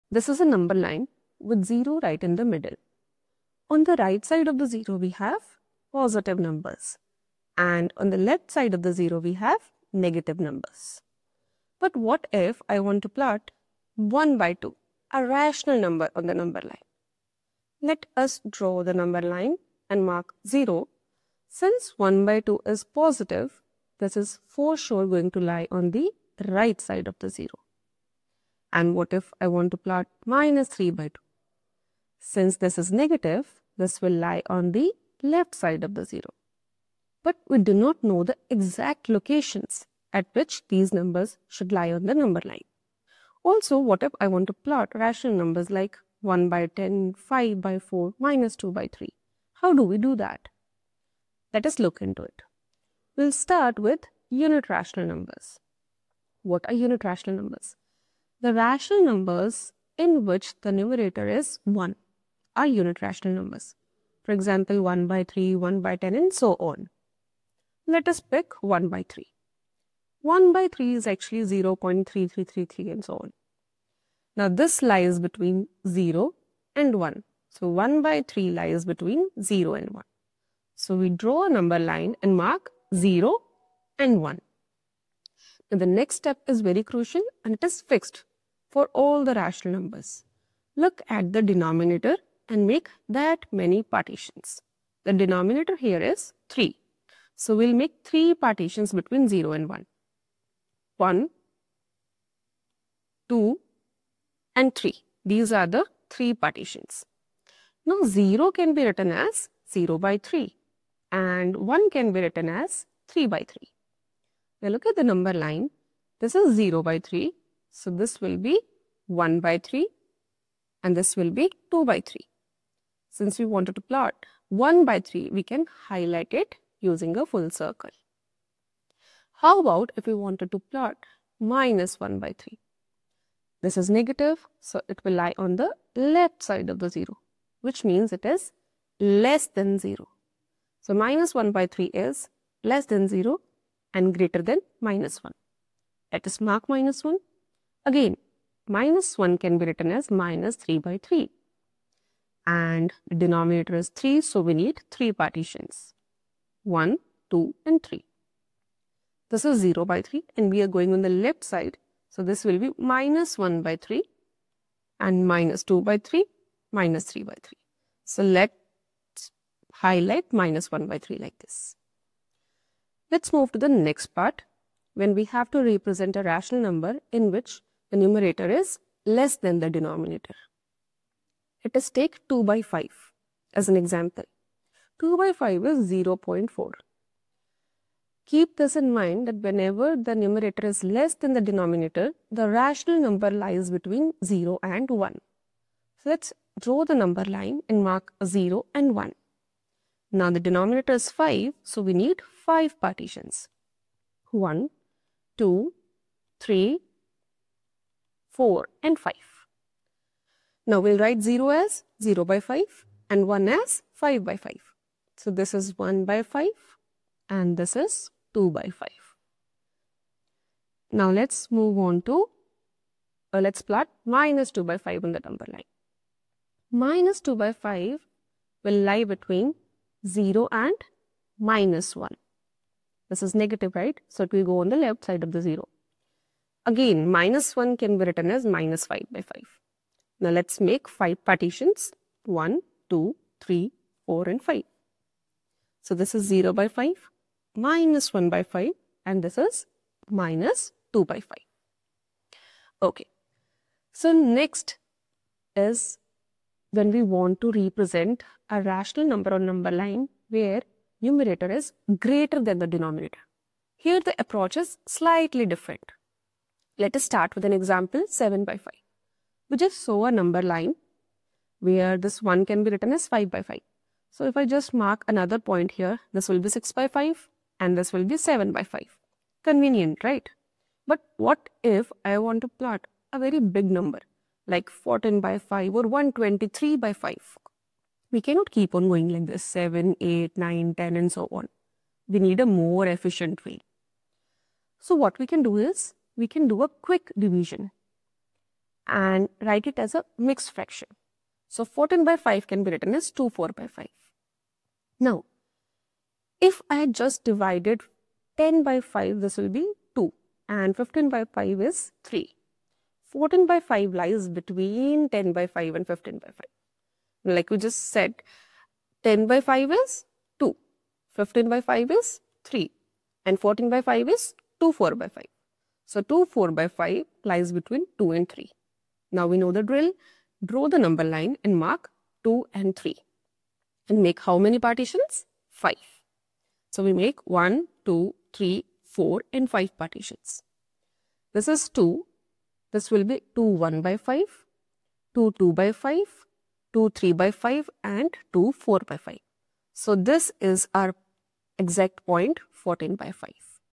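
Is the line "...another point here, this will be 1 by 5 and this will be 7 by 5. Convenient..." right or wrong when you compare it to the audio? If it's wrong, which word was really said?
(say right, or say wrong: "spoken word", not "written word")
wrong: "6", not "1".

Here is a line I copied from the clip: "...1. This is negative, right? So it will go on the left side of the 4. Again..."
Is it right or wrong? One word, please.
wrong.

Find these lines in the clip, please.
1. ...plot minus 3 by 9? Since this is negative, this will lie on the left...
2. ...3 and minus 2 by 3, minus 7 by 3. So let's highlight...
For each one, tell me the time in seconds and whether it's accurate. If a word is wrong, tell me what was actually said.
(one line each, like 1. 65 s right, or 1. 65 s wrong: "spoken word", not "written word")
1. 29 s wrong: "2", not "9"
2. 163 s wrong: "3", not "7".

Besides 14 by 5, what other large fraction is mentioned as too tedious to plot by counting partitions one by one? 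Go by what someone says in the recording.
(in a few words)
123/5.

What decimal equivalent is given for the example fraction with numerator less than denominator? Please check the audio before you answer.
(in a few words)
0.4.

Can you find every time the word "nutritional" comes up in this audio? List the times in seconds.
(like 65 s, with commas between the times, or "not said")
not said.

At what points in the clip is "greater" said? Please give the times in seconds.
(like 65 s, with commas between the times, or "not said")
144 s, 261 s.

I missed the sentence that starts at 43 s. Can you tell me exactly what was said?
Also, what if I want to plot rational numbers like 1 by 10, 5 by 4, minus 2 by 3?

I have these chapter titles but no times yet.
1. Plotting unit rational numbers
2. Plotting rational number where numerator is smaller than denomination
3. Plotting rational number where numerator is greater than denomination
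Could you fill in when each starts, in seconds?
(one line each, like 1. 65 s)
1. 55 s
2. 175 s
3. 255 s.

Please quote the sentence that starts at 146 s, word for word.
Let us mark minus 1 Again, minus 1 can be written as minus 3 by 3.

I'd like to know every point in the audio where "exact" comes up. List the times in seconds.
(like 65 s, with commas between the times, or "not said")
38 s, 351 s.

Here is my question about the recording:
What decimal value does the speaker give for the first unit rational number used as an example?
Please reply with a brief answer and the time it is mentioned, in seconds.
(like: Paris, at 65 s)
0.3333, at 71 s.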